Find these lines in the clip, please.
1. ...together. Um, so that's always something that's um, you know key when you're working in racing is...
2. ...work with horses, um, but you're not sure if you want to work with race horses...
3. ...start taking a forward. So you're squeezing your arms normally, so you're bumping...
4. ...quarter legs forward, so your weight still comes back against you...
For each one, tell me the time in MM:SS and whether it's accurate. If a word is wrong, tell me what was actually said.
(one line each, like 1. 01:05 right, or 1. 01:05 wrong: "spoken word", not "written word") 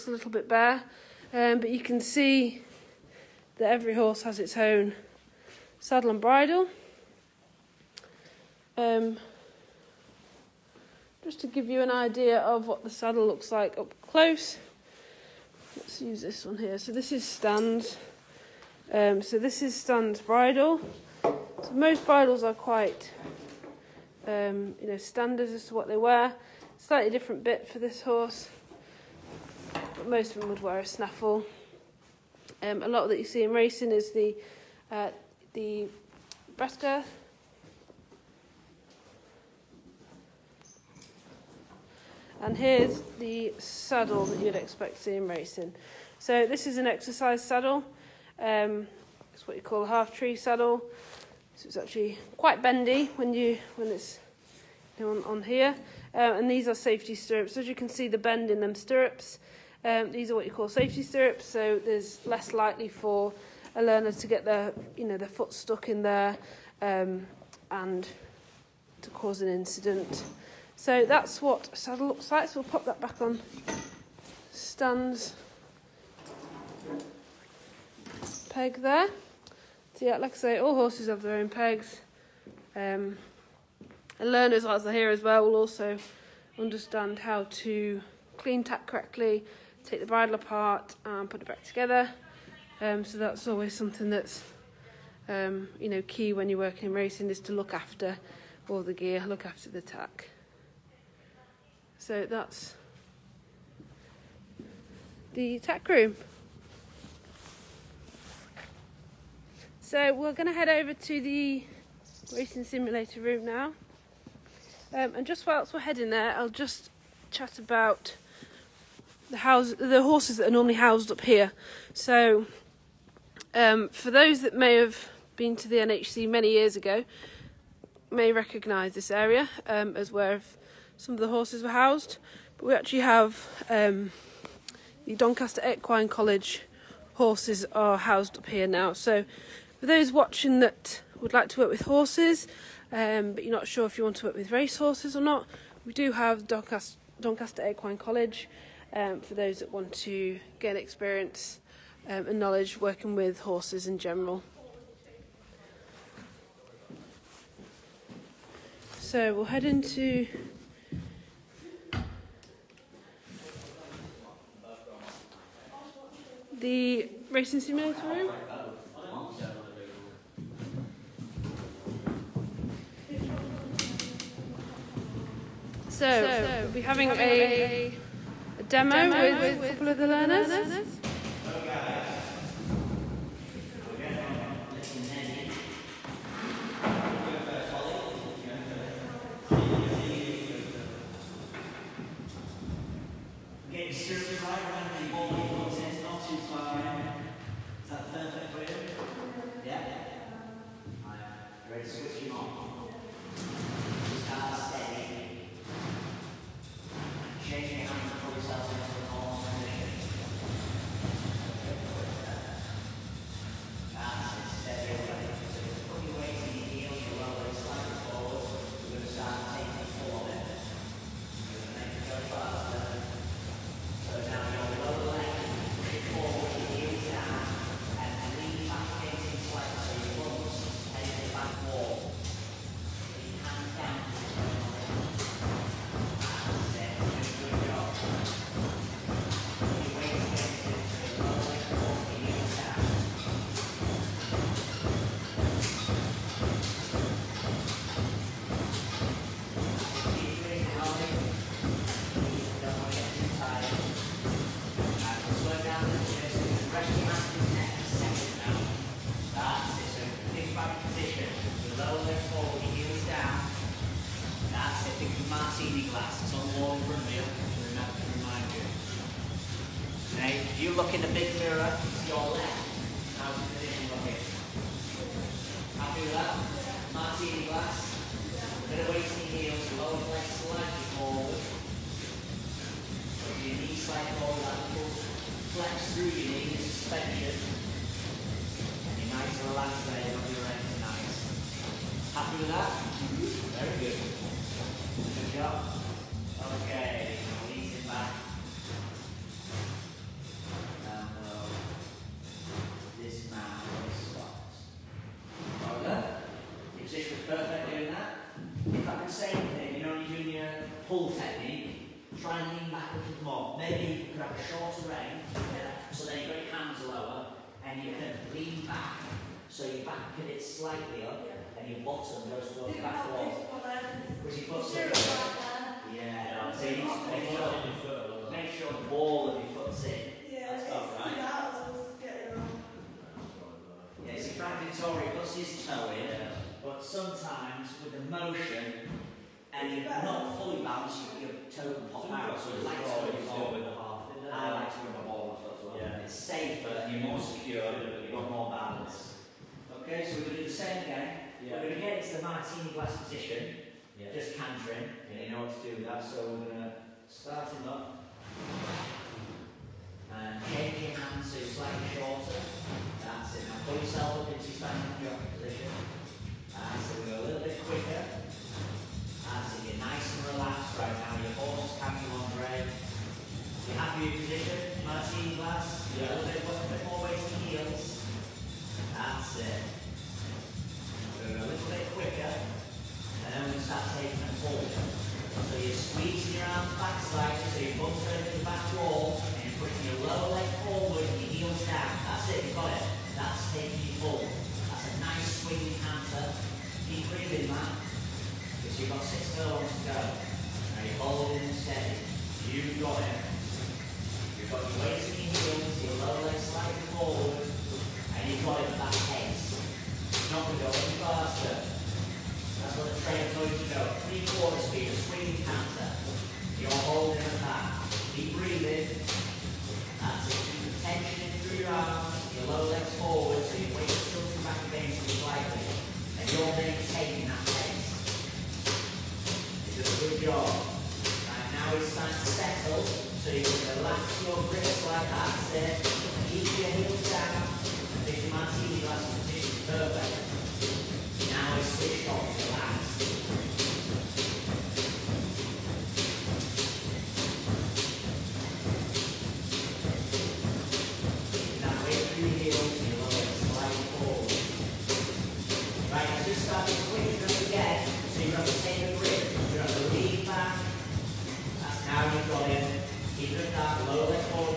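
1. 01:31 right
2. 02:21 right
3. 06:23 wrong: "slightly", not "normally"
4. 07:02 wrong: "lower", not "quarter".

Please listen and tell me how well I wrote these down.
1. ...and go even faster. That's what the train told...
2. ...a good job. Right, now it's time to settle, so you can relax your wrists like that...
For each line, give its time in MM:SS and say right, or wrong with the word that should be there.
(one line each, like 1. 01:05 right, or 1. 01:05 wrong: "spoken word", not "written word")
1. 06:50 right
2. 07:09 right.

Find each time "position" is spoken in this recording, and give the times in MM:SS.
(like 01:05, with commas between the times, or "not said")
03:29, 05:53, 06:05, 06:14.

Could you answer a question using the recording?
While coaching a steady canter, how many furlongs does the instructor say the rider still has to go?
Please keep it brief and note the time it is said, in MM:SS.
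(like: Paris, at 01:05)
6, at 06:39.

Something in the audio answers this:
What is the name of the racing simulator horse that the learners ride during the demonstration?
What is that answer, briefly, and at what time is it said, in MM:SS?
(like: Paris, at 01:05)
Little Nelly, at 03:04.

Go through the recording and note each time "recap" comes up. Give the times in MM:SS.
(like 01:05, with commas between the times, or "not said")
not said.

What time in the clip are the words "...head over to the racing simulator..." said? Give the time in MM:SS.
01:50.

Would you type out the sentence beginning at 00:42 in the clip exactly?
And here's the saddle that you'd expect to see in racing.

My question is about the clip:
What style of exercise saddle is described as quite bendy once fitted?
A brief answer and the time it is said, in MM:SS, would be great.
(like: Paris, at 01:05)
half tree saddle, at 00:49.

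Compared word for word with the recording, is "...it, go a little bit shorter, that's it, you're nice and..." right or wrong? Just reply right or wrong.
wrong.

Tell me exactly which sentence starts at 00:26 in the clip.
Slightly different bit for this horse, but most of them would wear a snaffle.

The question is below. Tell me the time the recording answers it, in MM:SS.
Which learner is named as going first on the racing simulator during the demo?
03:07.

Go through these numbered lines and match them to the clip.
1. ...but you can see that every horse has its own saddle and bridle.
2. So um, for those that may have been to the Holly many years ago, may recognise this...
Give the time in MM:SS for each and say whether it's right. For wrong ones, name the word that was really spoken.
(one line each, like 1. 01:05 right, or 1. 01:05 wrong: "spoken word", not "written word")
1. 00:01 right
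2. 02:01 wrong: "NHC", not "Holly".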